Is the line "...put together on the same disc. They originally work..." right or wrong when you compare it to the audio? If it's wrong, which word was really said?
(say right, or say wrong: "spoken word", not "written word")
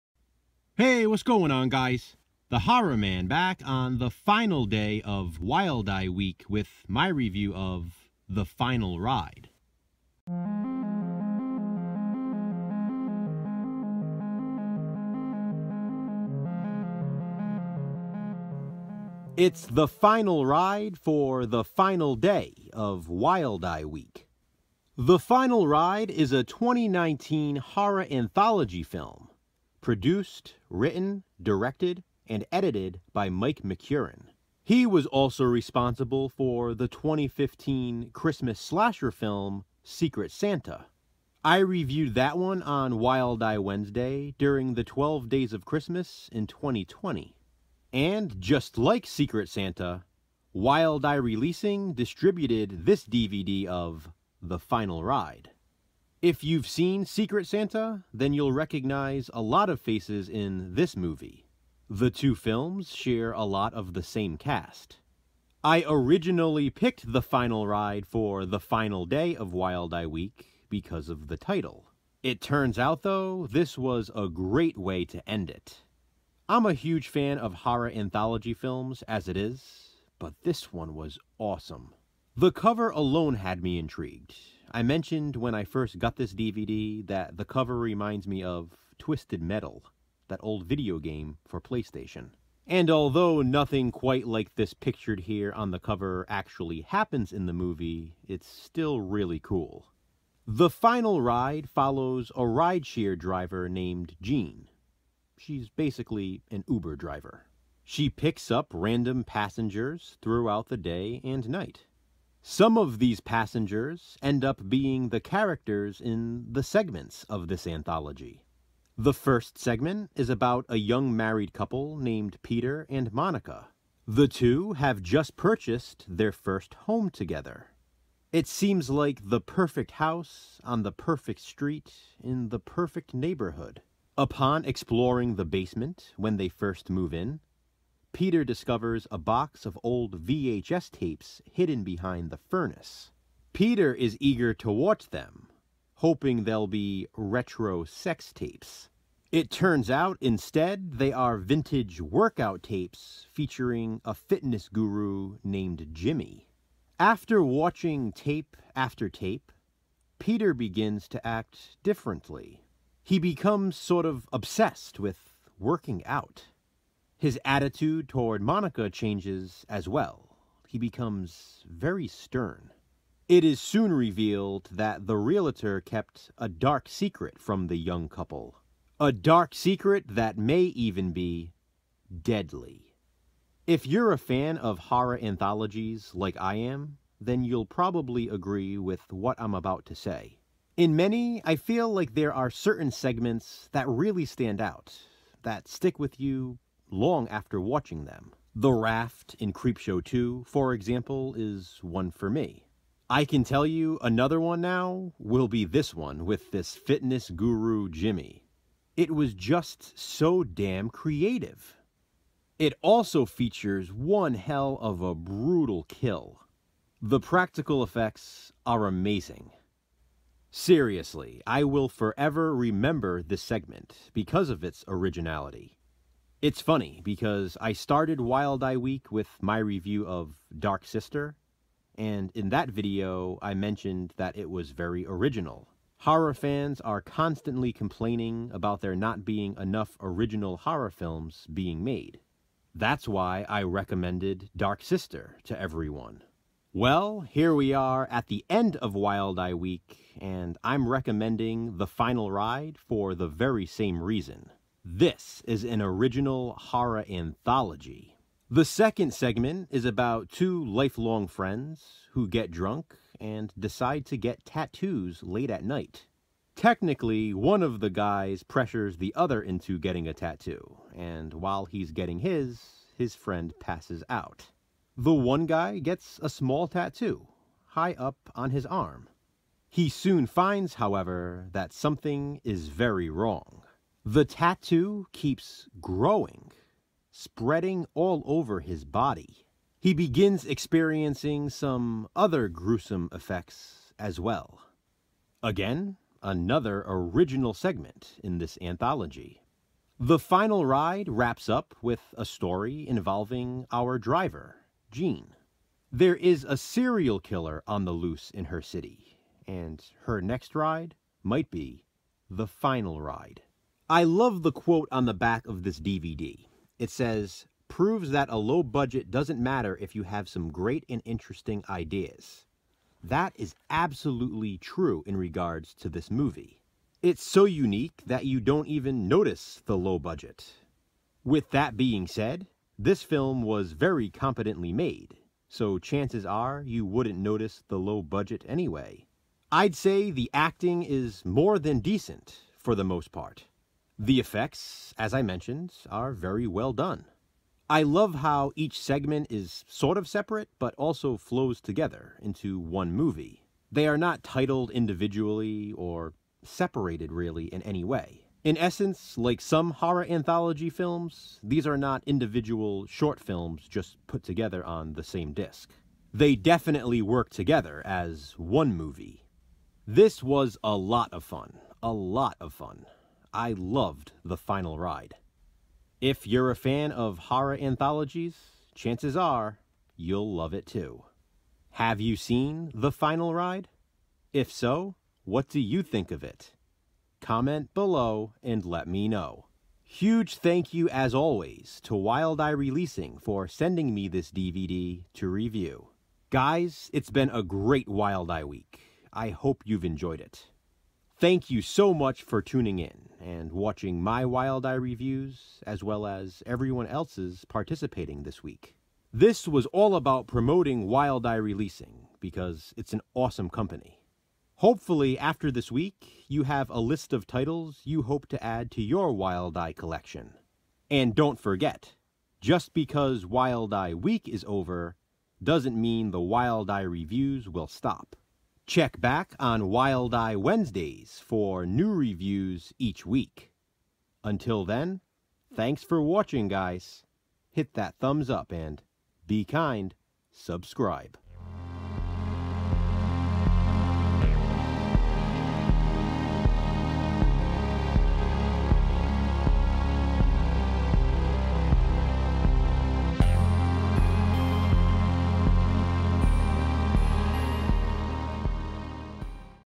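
wrong: "definitely", not "originally".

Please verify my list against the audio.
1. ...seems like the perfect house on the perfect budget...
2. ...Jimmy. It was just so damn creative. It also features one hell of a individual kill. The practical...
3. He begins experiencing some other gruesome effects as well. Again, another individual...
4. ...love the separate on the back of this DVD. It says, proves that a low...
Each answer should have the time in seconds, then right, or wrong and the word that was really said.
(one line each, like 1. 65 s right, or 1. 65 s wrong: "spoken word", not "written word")
1. 128 s wrong: "street", not "budget"
2. 207 s wrong: "brutal", not "individual"
3. 289 s wrong: "original", not "individual"
4. 314 s wrong: "quote", not "separate".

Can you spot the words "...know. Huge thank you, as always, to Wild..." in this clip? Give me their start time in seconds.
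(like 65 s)
389 s.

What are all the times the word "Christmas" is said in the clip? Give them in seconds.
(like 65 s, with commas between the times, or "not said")
38 s, 45 s.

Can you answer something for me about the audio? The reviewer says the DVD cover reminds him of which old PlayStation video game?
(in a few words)
Twisted Metal.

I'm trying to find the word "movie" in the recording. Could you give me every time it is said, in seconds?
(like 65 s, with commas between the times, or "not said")
60 s, 97 s, 326 s, 352 s, 368 s.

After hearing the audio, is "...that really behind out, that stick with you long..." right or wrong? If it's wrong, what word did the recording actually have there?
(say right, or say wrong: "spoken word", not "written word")
wrong: "stand", not "behind".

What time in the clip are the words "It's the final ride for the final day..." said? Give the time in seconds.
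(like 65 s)
19 s.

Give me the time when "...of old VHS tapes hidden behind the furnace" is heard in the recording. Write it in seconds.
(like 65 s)
139 s.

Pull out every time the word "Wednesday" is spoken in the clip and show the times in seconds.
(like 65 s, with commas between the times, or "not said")
43 s, 430 s.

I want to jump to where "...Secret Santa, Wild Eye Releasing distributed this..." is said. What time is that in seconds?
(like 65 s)
49 s.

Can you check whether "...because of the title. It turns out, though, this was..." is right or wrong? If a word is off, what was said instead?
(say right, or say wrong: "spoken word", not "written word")
right.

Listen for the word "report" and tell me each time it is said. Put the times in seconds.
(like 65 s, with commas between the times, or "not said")
not said.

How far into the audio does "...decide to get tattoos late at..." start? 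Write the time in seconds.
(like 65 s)
263 s.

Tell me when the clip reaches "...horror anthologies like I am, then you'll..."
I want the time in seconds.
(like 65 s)
184 s.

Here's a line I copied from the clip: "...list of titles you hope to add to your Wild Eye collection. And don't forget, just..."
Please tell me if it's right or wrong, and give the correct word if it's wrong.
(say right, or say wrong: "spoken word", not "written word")
right.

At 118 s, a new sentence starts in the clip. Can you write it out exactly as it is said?
The first segment is about a young married couple named Peter and Monica.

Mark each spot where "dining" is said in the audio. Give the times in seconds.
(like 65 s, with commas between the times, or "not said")
not said.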